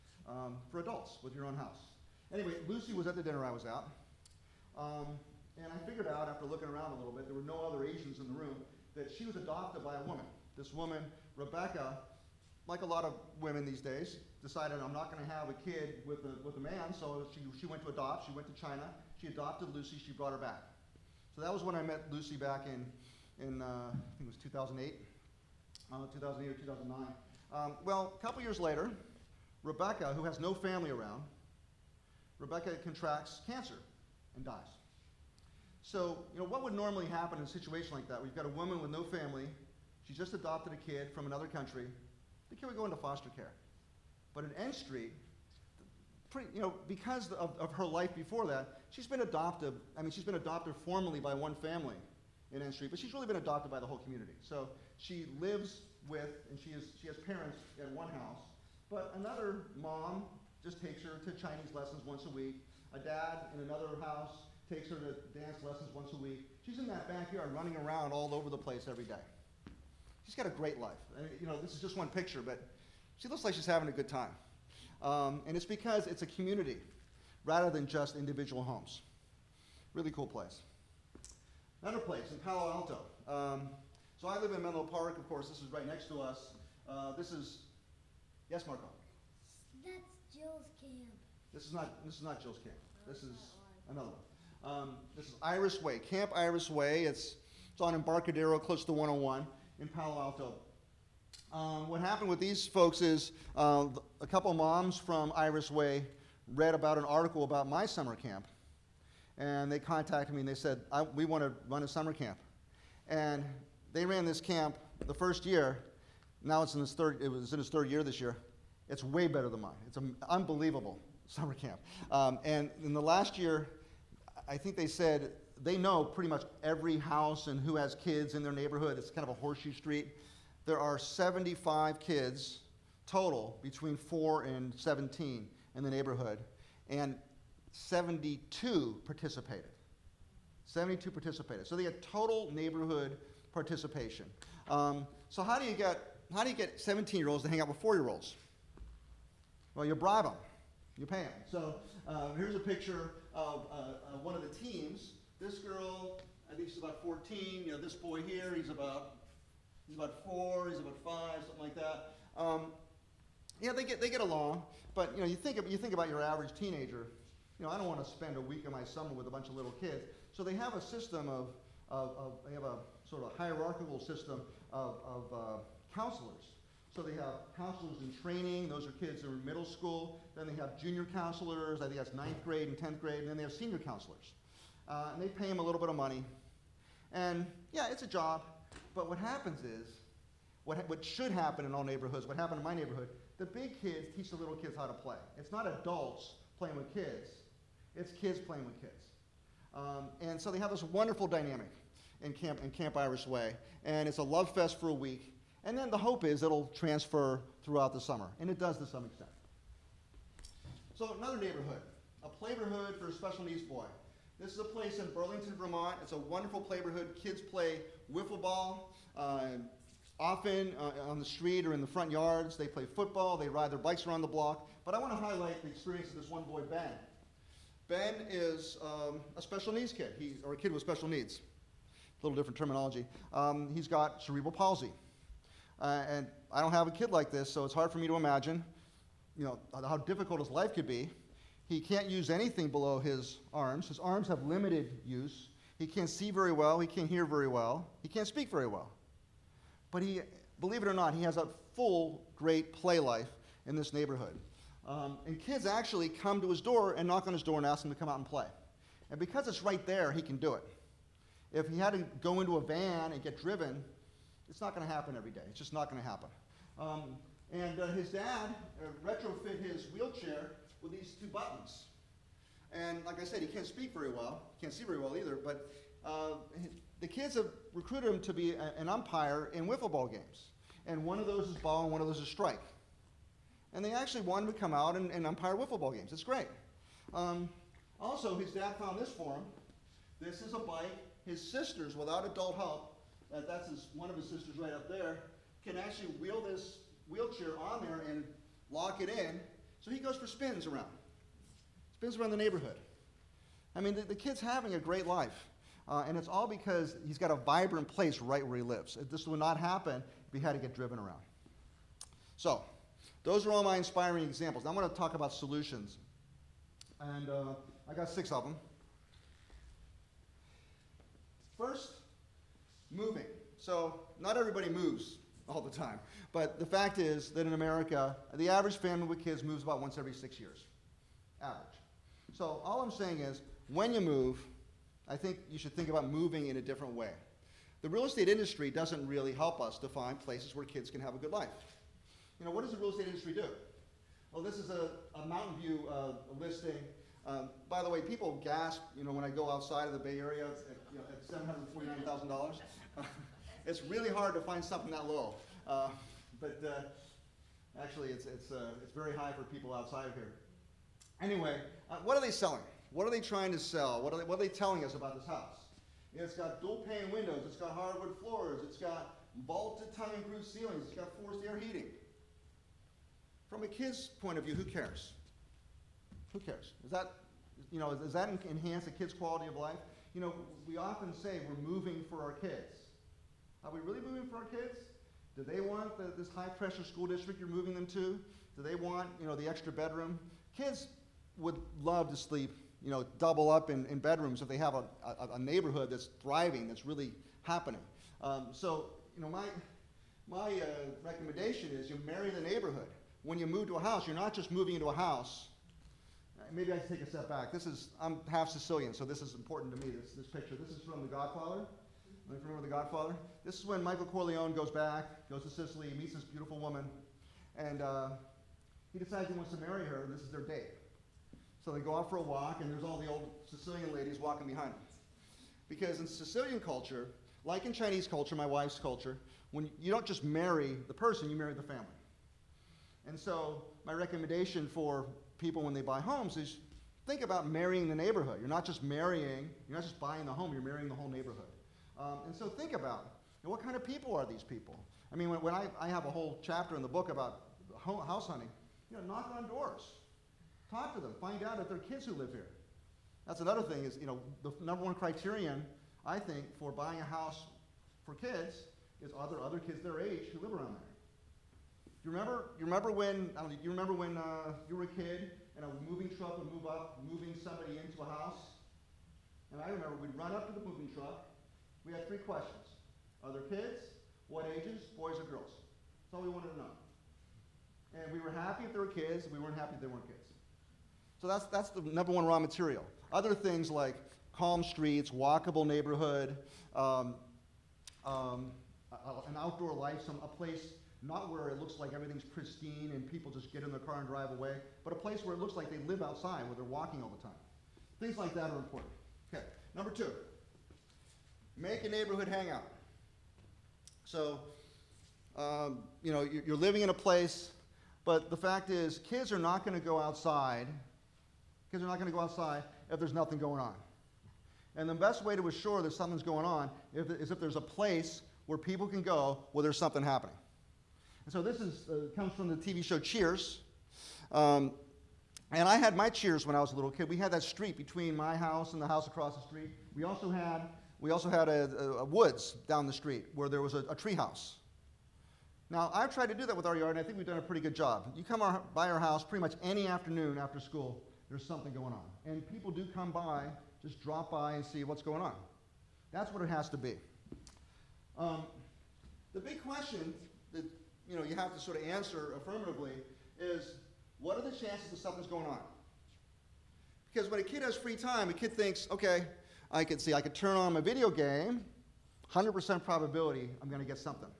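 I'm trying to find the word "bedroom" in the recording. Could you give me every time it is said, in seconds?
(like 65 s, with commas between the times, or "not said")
389 s, 393 s.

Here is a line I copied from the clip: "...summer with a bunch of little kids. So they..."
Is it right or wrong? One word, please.
right.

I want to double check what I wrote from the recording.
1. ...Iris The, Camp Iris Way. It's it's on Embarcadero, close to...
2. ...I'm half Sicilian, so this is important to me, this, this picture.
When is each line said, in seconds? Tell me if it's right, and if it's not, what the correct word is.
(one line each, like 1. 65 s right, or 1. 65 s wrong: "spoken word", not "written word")
1. 95 s wrong: "Way", not "The"
2. 407 s right.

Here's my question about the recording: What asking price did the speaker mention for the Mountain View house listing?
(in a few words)
$749,000.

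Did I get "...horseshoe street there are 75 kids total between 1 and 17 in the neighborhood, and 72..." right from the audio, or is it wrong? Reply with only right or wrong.
wrong.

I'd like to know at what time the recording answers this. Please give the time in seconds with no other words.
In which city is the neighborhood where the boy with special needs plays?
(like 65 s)
215 s.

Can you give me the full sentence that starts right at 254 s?
Um, and kids actually come to his door and knock on his door and ask him to come out and play.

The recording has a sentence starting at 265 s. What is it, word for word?
It's just not going to happen.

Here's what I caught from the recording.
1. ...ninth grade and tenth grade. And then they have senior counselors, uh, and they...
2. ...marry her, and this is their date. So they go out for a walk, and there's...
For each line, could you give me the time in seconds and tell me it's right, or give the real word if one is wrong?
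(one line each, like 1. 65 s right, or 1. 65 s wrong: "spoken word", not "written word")
1. 182 s right
2. 419 s right.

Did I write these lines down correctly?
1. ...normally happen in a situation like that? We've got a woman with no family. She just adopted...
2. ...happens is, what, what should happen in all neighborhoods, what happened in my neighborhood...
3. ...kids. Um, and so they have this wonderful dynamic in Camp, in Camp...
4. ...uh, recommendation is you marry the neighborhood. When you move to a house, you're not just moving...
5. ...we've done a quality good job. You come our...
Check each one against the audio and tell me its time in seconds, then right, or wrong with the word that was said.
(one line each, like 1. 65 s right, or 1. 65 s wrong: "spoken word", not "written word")
1. 36 s right
2. 189 s right
3. 198 s right
4. 400 s right
5. 537 s wrong: "pretty", not "quality".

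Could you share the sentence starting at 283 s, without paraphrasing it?
And they actually want him to come out and, and umpire wiffle ball games.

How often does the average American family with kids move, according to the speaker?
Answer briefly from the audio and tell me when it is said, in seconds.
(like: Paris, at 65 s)
Every 6 years, at 329 s.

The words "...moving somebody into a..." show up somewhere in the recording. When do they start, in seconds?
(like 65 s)
467 s.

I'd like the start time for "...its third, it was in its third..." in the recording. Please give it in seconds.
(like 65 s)
116 s.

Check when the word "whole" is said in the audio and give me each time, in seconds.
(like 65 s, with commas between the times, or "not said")
53 s, 440 s, 446 s.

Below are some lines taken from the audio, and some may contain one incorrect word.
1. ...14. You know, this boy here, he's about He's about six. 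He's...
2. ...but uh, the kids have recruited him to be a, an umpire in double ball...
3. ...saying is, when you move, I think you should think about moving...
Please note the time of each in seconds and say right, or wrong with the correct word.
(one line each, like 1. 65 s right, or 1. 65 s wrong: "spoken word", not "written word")
1. 157 s wrong: "four", not "six"
2. 275 s wrong: "wiffle", not "double"
3. 332 s right.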